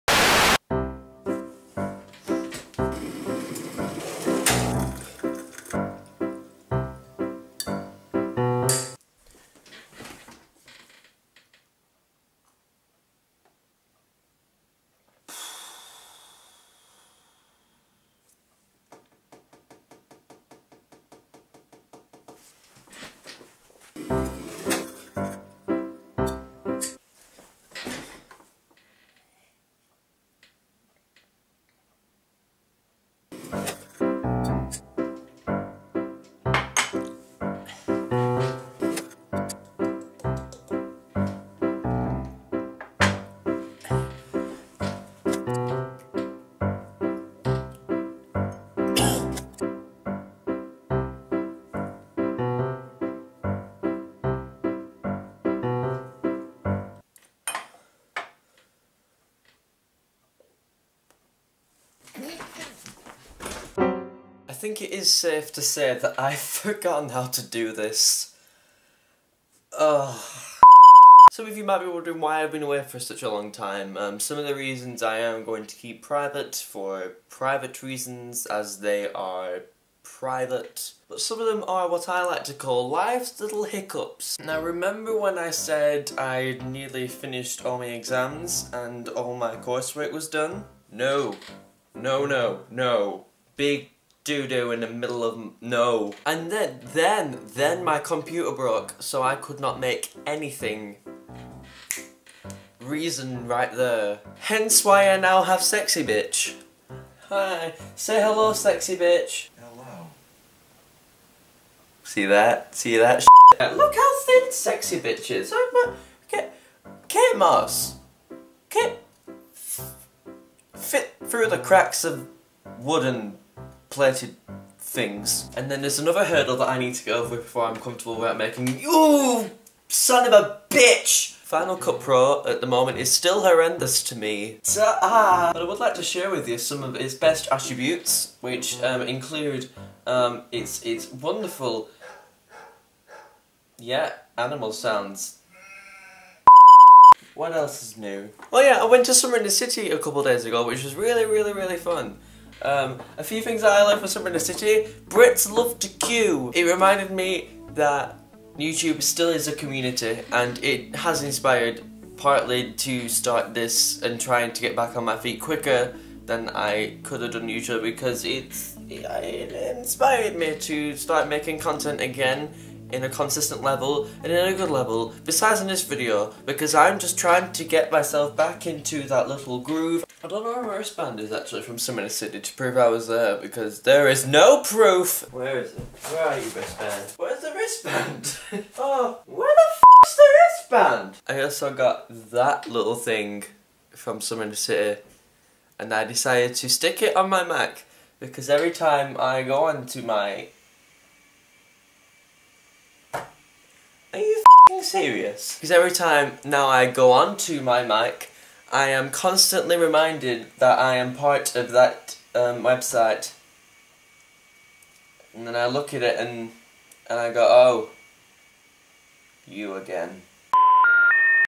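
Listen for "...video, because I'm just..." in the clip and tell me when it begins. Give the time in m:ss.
2:55.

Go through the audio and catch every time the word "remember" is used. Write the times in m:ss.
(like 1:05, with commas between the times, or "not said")
1:24.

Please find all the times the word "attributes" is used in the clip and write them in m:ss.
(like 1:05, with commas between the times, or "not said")
2:17.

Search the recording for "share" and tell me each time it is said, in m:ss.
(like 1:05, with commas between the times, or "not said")
2:16.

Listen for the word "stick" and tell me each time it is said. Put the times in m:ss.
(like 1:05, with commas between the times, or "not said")
3:16.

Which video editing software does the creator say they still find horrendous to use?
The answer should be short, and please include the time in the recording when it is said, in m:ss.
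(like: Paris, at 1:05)
Final Cut Pro, at 2:11.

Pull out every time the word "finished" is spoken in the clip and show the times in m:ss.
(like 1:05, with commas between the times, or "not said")
1:27.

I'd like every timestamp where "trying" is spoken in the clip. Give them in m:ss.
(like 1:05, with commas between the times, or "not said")
2:44, 2:57.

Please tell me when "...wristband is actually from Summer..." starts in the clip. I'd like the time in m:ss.
3:00.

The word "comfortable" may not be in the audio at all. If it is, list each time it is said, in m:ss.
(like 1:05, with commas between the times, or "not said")
2:07.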